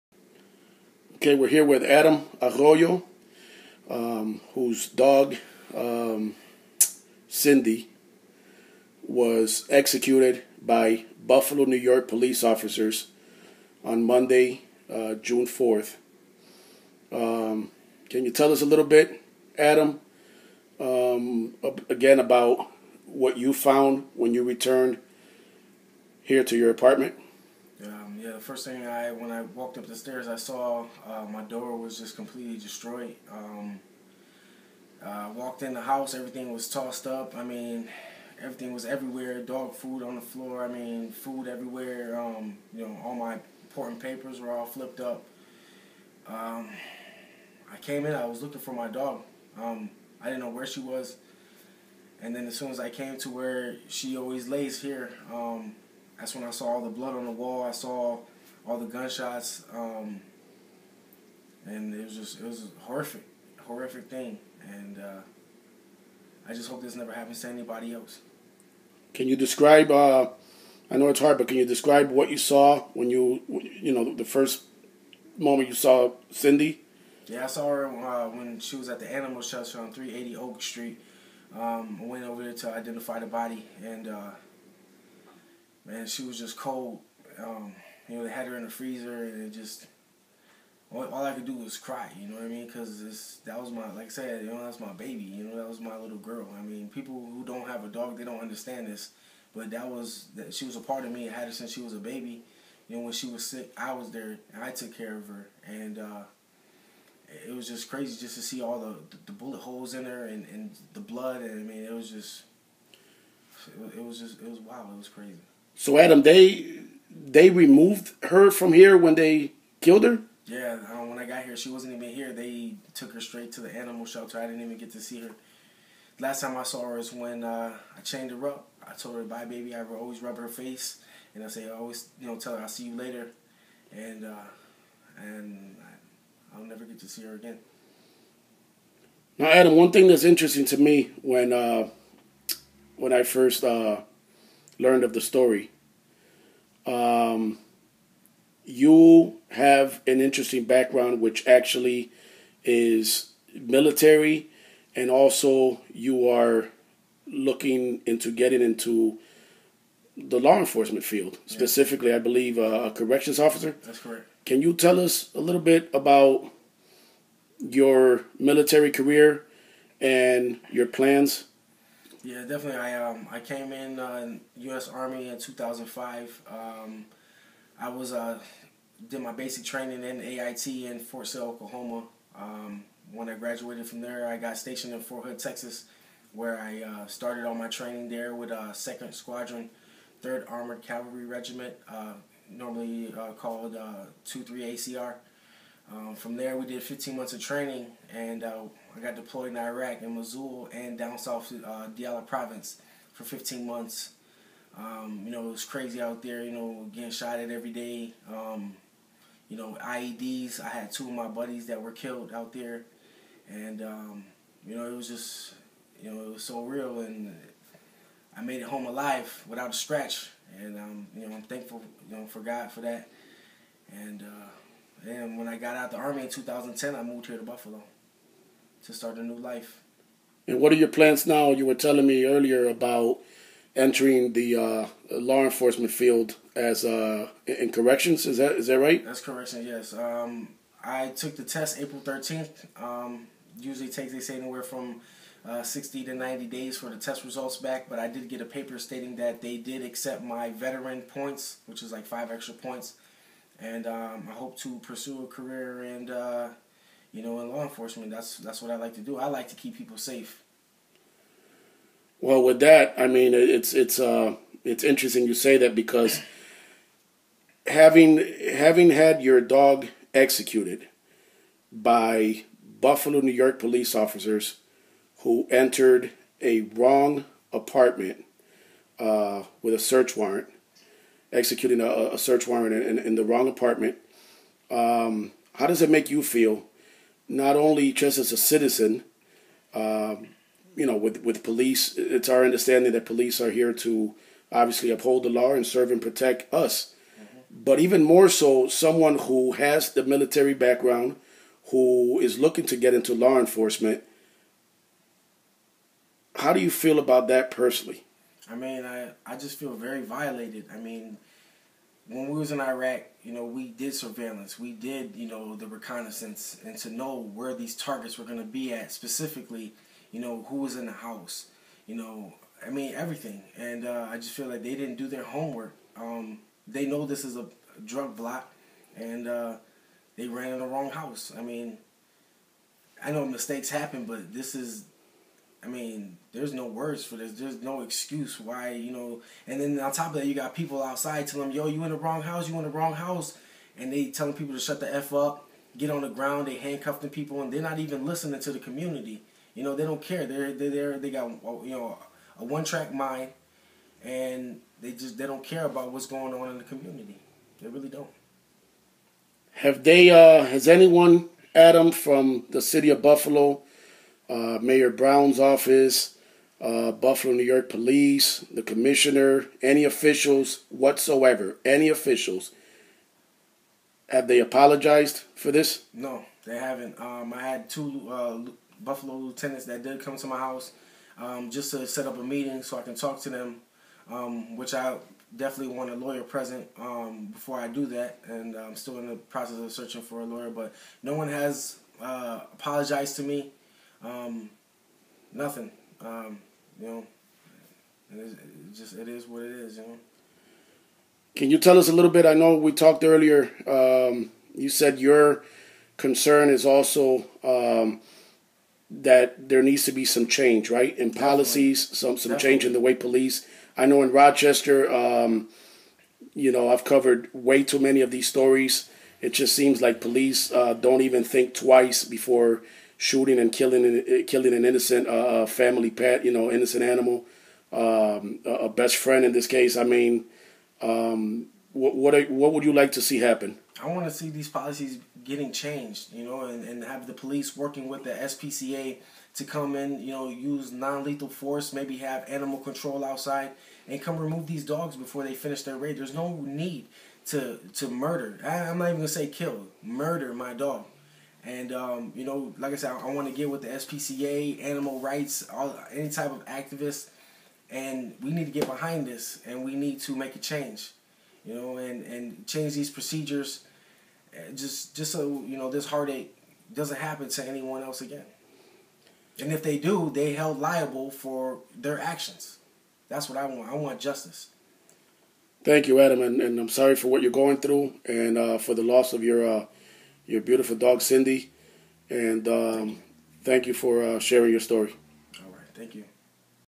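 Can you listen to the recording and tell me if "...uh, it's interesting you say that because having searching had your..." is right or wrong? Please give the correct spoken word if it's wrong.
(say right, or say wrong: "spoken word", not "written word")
wrong: "having", not "searching".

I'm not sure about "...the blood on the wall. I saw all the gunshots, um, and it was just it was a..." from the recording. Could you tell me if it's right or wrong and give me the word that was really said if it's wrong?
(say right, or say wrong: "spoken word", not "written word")
right.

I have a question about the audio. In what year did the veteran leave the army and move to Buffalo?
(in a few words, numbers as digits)
2010.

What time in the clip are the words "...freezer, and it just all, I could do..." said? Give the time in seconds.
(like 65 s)
88 s.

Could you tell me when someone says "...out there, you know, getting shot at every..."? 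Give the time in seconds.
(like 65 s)
206 s.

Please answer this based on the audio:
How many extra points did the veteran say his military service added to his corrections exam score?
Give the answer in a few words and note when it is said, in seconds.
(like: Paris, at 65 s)
5, at 252 s.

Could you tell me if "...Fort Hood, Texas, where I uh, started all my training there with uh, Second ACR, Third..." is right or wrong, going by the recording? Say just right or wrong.
wrong.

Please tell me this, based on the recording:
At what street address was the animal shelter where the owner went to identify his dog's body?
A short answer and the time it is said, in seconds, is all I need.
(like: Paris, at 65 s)
380 Oak Street, at 79 s.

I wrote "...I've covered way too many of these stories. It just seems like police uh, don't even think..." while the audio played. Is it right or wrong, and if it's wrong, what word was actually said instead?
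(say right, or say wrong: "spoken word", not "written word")
right.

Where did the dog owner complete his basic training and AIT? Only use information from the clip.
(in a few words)
Fort Sill, Oklahoma.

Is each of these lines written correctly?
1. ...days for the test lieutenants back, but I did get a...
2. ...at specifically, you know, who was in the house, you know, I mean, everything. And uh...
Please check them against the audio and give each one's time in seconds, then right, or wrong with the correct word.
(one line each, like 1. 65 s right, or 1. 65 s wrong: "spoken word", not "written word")
1. 246 s wrong: "results", not "lieutenants"
2. 318 s right.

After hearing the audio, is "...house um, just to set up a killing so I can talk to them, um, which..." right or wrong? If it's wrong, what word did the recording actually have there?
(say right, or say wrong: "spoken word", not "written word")
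wrong: "meeting", not "killing".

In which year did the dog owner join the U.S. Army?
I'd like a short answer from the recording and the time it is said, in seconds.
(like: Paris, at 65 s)
2005, at 175 s.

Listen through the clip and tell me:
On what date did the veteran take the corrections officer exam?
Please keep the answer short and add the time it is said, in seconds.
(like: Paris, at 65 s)
April 13, at 241 s.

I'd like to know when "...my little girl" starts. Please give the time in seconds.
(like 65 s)
95 s.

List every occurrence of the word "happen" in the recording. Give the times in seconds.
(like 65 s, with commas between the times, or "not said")
67 s, 333 s, 433 s, 466 s.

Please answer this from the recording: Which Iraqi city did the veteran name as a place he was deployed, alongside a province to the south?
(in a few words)
Mosul.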